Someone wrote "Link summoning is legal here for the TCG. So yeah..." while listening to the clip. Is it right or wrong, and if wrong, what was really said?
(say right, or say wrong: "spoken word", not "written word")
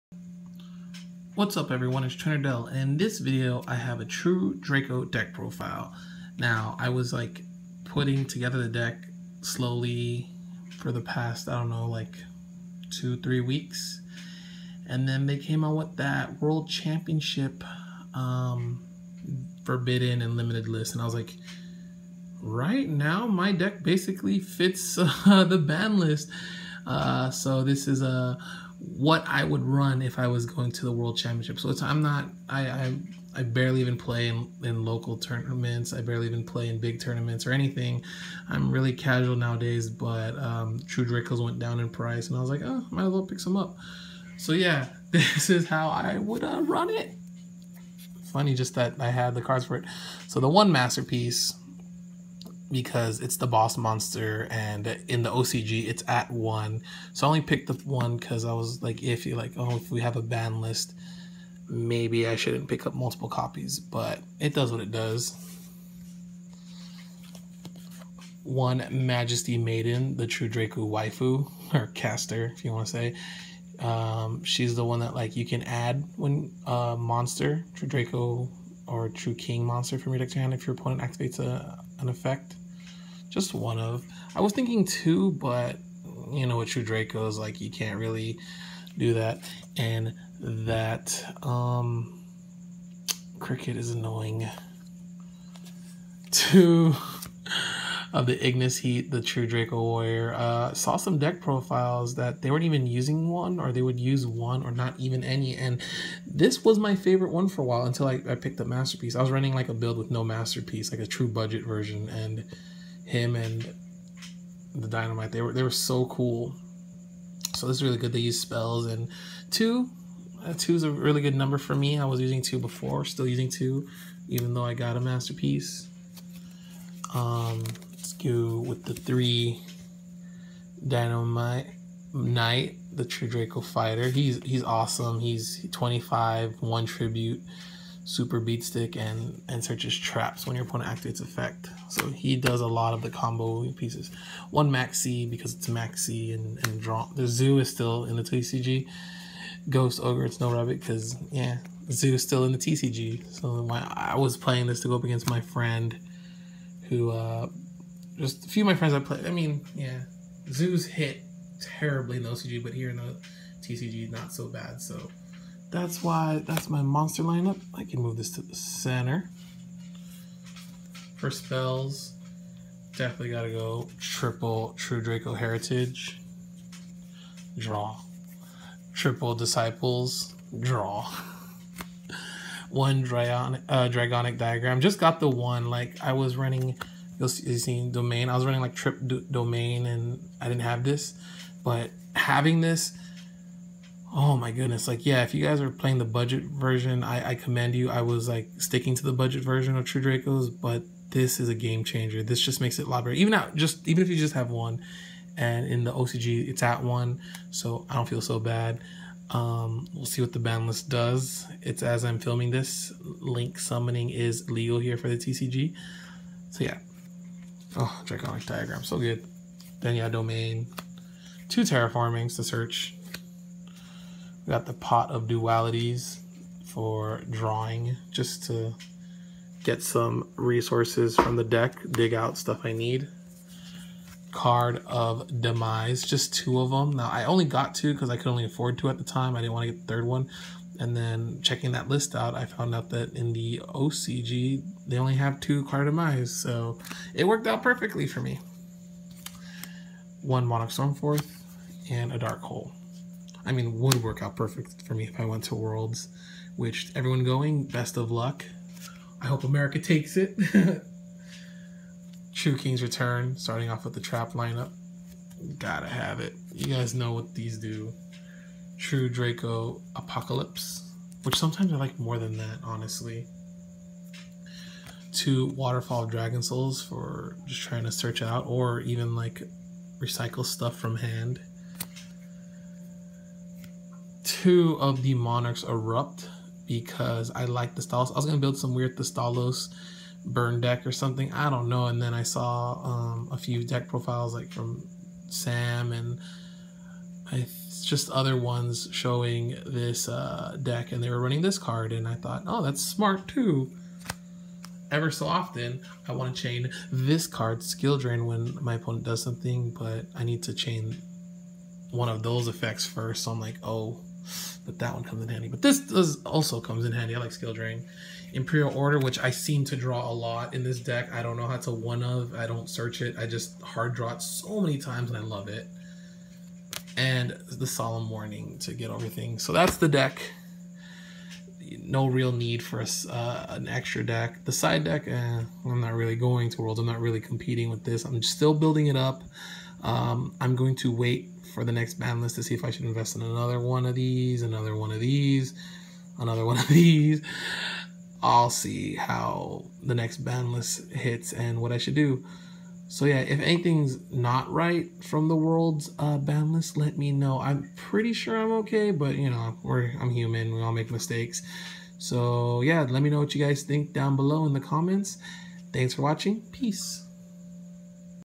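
right.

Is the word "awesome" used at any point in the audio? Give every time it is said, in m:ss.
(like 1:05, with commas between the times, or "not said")
2:14.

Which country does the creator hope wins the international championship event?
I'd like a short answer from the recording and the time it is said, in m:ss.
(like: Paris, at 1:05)
America, at 4:19.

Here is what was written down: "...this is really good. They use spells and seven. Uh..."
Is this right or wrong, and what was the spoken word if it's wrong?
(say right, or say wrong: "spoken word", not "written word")
wrong: "two", not "seven".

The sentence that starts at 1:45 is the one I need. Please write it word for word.
And this was my favorite one for a while until I, I picked up Master Peace.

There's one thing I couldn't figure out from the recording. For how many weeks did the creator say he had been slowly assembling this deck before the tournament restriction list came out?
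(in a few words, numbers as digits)
2-3 weeks.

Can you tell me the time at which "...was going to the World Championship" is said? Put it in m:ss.
0:30.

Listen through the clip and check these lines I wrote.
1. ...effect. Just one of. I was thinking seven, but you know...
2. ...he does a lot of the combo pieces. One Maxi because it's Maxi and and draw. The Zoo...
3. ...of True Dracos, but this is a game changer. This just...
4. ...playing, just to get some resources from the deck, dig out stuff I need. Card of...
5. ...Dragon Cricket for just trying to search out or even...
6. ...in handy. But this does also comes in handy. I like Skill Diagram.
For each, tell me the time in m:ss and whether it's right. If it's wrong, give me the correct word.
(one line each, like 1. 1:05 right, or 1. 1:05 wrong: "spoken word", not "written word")
1. 1:22 wrong: "two", not "seven"
2. 2:22 right
3. 3:19 right
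4. 3:47 wrong: "drawing", not "playing"
5. 4:36 wrong: "Souls", not "Cricket"
6. 5:15 wrong: "Drain", not "Diagram".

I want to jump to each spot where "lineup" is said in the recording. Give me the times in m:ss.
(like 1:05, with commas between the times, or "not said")
2:47, 4:24.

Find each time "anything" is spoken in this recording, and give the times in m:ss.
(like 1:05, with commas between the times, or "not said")
0:37, 5:53.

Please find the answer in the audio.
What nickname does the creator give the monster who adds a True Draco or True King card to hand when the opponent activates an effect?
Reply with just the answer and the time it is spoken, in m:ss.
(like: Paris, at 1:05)
True Draco waifu, at 1:10.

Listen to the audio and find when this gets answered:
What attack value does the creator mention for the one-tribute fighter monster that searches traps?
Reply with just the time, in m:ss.
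2:15.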